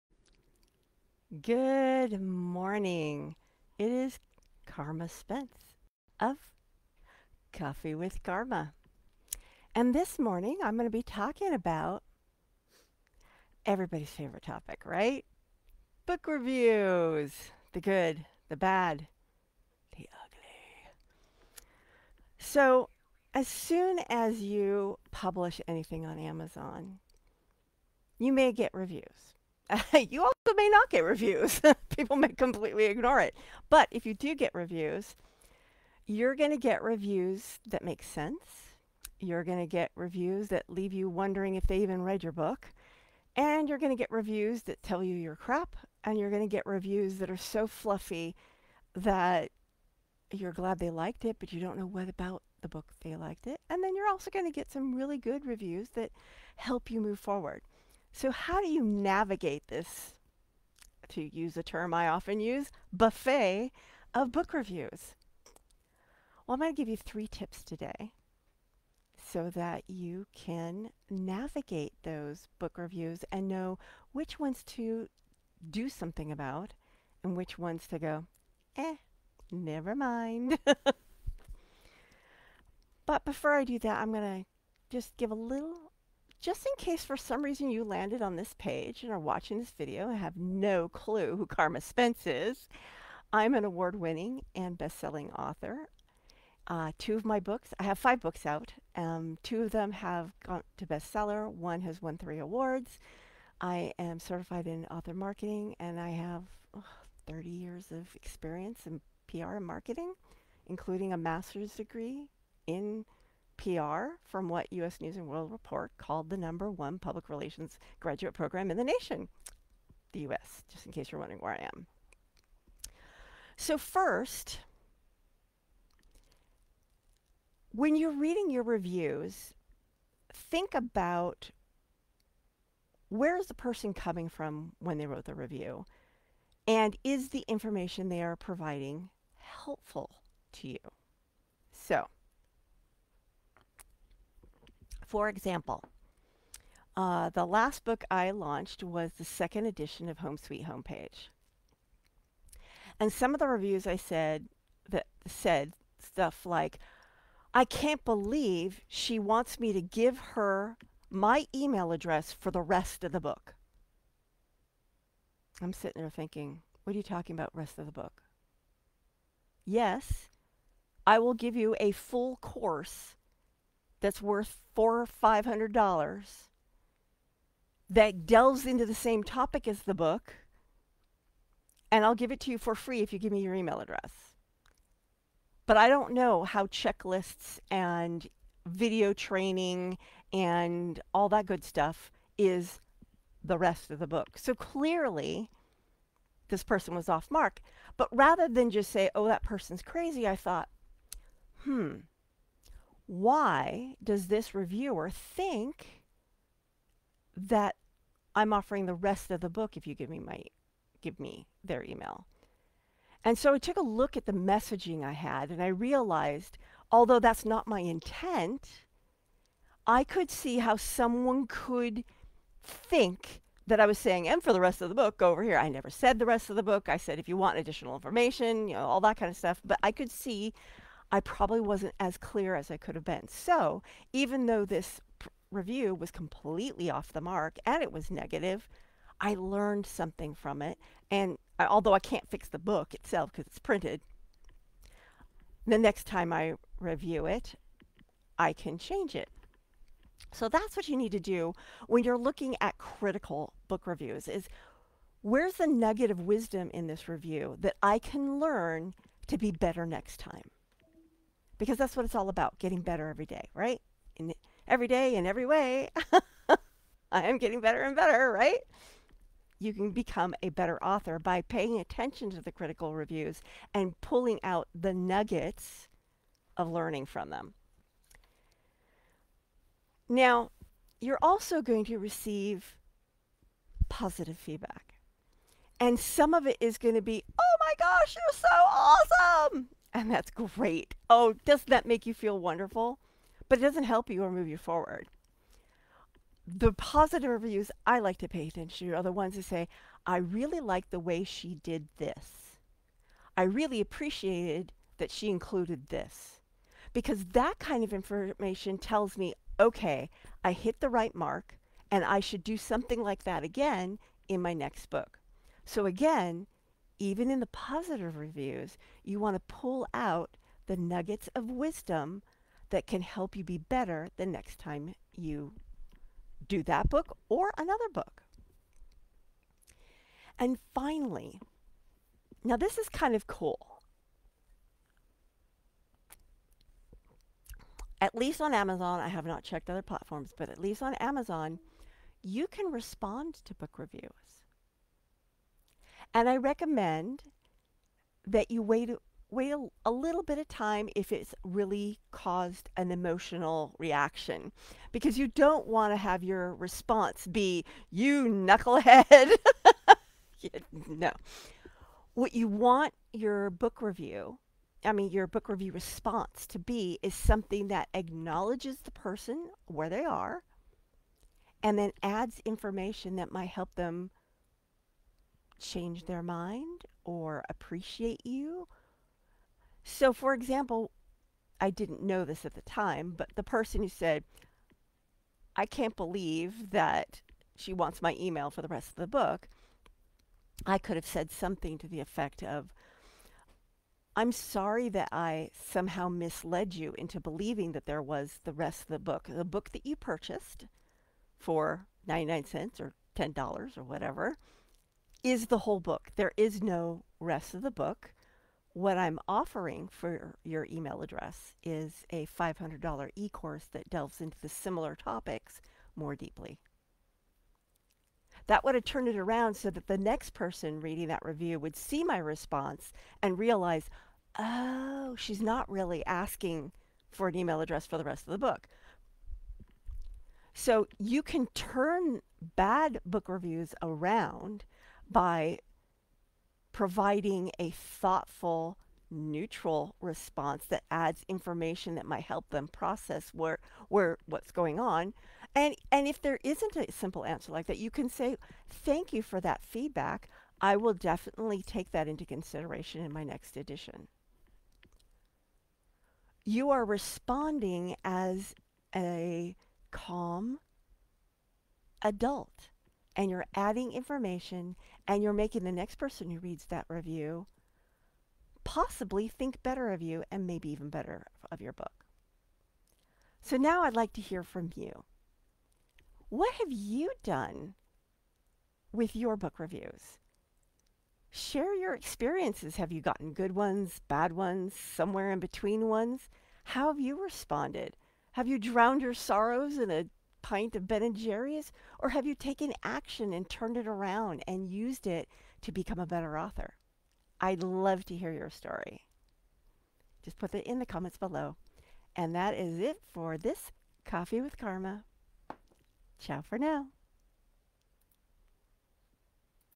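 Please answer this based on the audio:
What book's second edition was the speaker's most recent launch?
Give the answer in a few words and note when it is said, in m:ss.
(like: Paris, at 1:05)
Home Sweet Homepage, at 2:30.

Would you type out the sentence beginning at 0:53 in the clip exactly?
And then you're also going to get some really good reviews that help you move forward.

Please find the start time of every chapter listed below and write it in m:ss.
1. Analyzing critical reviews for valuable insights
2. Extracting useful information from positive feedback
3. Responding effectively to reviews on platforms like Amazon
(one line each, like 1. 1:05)
1. 2:45
2. 5:20
3. 8:10.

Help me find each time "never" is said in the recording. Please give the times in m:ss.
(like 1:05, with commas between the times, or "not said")
1:19, 3:45.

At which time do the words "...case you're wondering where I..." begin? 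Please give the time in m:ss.
2:00.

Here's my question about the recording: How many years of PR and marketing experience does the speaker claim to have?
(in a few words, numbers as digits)
30.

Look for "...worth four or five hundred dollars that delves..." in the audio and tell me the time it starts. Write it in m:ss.
2:54.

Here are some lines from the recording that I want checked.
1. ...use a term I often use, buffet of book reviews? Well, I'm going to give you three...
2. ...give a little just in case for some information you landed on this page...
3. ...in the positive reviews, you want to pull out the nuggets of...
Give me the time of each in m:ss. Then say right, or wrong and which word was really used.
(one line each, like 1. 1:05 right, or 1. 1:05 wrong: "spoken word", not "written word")
1. 1:01 right
2. 1:25 wrong: "reason", not "information"
3. 5:17 right.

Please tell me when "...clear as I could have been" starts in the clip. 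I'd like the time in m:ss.
3:52.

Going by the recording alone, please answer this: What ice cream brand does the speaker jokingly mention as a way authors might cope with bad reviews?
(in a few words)
Ben and Jerry's.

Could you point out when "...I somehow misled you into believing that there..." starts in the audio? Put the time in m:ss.
6:35.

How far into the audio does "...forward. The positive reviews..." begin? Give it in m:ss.
4:54.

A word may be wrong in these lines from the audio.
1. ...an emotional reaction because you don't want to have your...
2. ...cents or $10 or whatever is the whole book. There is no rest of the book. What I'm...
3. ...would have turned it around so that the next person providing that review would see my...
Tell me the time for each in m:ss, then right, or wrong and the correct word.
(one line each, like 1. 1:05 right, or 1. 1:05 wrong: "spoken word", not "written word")
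1. 5:52 right
2. 6:42 right
3. 6:58 wrong: "reading", not "providing".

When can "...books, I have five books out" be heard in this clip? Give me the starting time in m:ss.
1:37.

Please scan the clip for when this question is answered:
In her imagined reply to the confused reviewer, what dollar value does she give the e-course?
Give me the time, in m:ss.
6:52.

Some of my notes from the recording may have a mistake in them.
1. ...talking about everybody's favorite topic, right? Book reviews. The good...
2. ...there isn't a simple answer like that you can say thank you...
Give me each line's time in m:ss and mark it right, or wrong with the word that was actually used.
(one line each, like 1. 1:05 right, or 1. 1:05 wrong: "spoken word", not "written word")
1. 0:11 right
2. 7:26 right.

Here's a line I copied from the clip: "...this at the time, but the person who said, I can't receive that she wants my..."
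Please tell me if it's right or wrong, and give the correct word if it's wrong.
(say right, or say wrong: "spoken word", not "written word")
wrong: "believe", not "receive".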